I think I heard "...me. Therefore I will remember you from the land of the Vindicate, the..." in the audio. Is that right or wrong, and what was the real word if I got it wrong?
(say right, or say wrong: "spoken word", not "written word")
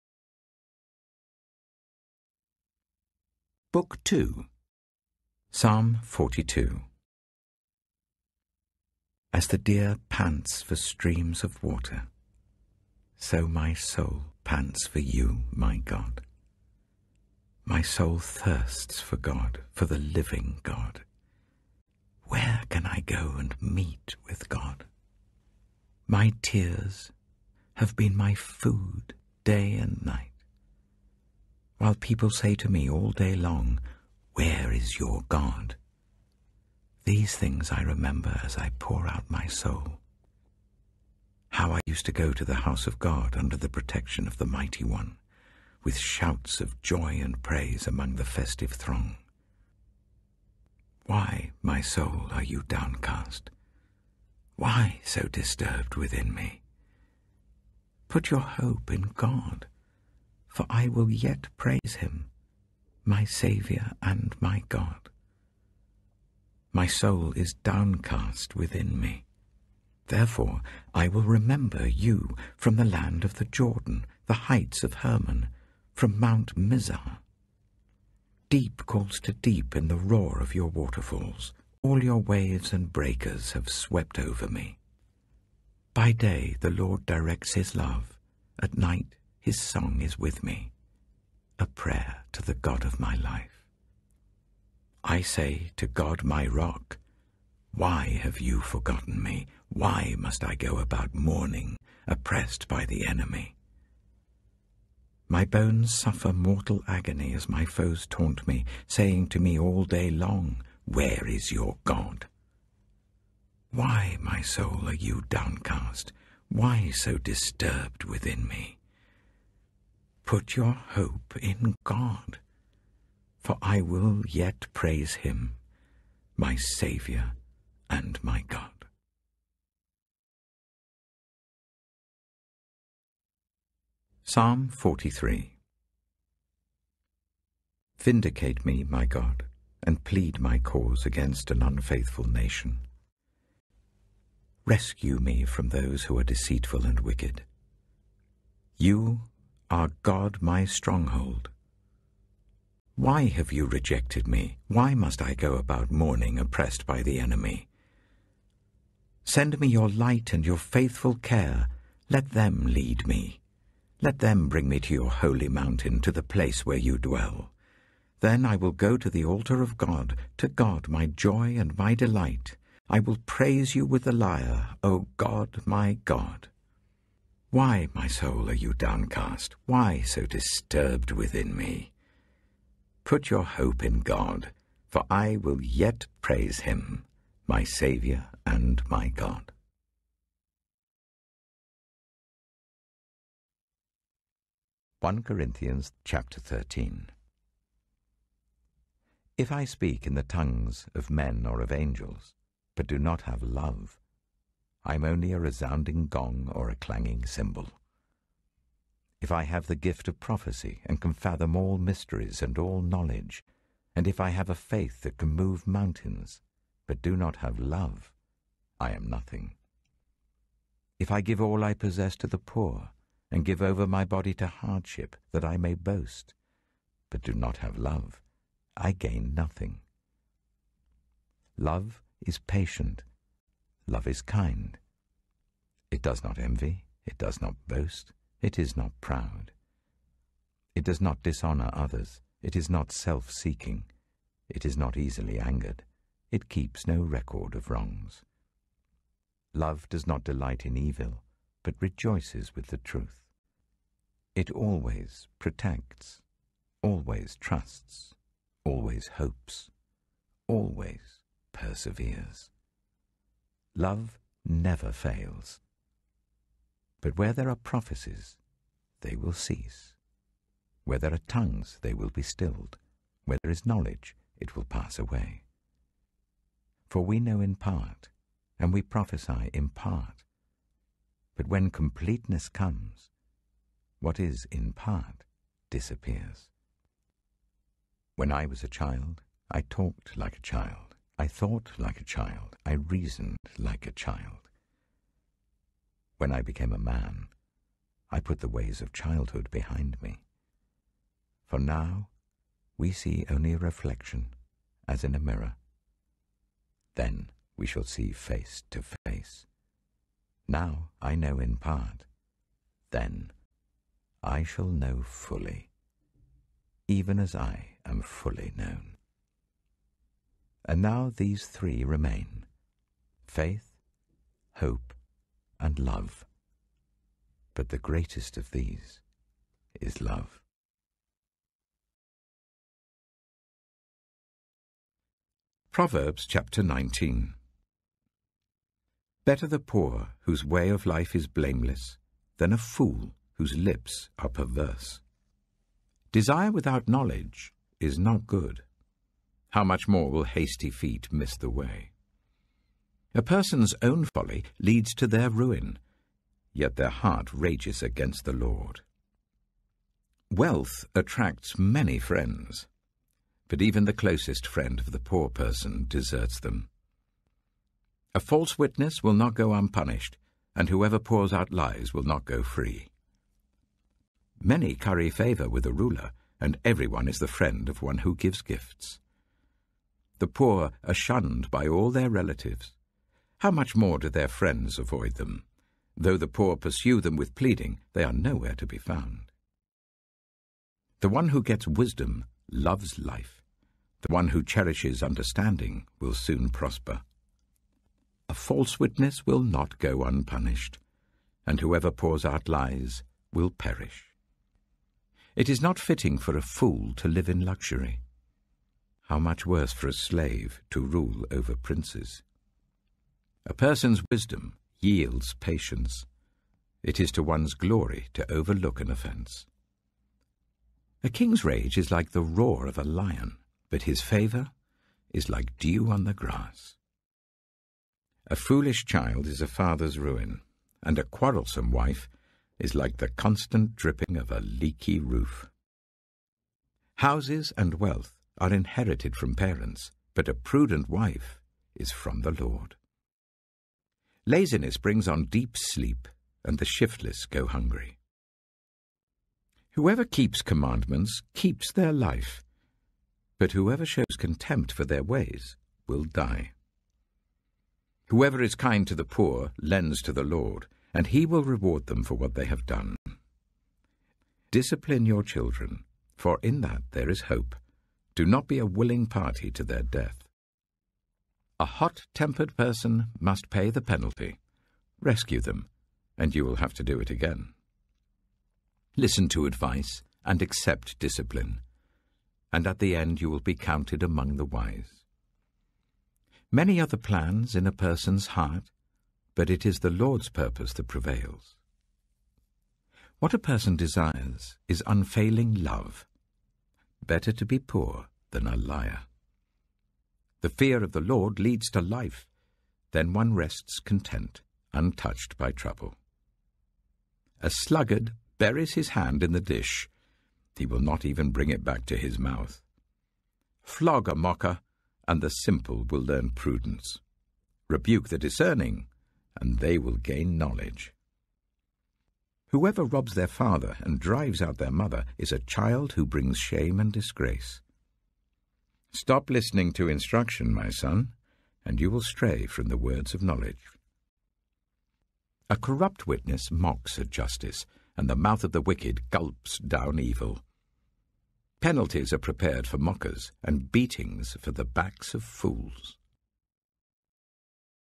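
wrong: "Jordan", not "Vindicate".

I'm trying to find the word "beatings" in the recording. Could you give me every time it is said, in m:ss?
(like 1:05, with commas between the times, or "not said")
9:03.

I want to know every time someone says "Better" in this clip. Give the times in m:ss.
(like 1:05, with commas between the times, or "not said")
5:39, 8:17.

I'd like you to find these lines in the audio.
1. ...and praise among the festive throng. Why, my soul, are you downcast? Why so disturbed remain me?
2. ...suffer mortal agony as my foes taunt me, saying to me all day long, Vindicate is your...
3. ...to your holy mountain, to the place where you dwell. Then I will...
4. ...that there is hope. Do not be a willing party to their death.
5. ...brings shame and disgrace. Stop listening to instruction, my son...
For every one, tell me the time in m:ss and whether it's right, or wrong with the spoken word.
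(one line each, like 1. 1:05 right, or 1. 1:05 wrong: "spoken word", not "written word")
1. 0:47 wrong: "within", not "remain"
2. 1:45 wrong: "Where", not "Vindicate"
3. 2:44 right
4. 7:46 right
5. 8:46 right.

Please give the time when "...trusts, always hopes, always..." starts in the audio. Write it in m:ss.
4:17.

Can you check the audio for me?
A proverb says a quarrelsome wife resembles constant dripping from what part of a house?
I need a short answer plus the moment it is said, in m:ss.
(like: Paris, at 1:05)
A leaky roof, at 7:14.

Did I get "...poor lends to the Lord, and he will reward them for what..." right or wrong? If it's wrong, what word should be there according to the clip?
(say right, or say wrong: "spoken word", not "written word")
right.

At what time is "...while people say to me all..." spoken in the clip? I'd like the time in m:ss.
0:31.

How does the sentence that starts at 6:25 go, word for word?
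Though the poor pursue them with pleading, they are nowhere to be found.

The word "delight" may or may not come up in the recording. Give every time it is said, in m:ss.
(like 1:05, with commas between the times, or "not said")
2:51, 4:10.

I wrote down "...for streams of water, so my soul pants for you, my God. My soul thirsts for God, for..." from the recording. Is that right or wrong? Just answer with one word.
right.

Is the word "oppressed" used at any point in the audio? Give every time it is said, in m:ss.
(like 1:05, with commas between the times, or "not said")
1:42, 2:36.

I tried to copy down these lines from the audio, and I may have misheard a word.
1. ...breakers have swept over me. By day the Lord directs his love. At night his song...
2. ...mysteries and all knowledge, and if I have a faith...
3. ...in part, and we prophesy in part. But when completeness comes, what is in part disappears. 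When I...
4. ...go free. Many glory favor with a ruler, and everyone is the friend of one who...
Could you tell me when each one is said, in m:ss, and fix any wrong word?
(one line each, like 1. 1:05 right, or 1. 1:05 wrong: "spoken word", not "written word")
1. 1:22 right
2. 3:31 right
3. 4:37 right
4. 6:12 wrong: "curry", not "glory".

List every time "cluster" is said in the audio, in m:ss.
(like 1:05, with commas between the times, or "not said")
not said.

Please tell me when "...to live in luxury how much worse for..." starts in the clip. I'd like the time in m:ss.
6:46.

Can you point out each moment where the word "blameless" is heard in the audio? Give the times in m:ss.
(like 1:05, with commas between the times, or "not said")
5:41.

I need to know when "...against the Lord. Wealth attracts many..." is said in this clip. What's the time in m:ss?
5:57.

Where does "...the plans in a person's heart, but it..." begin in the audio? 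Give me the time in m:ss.
8:06.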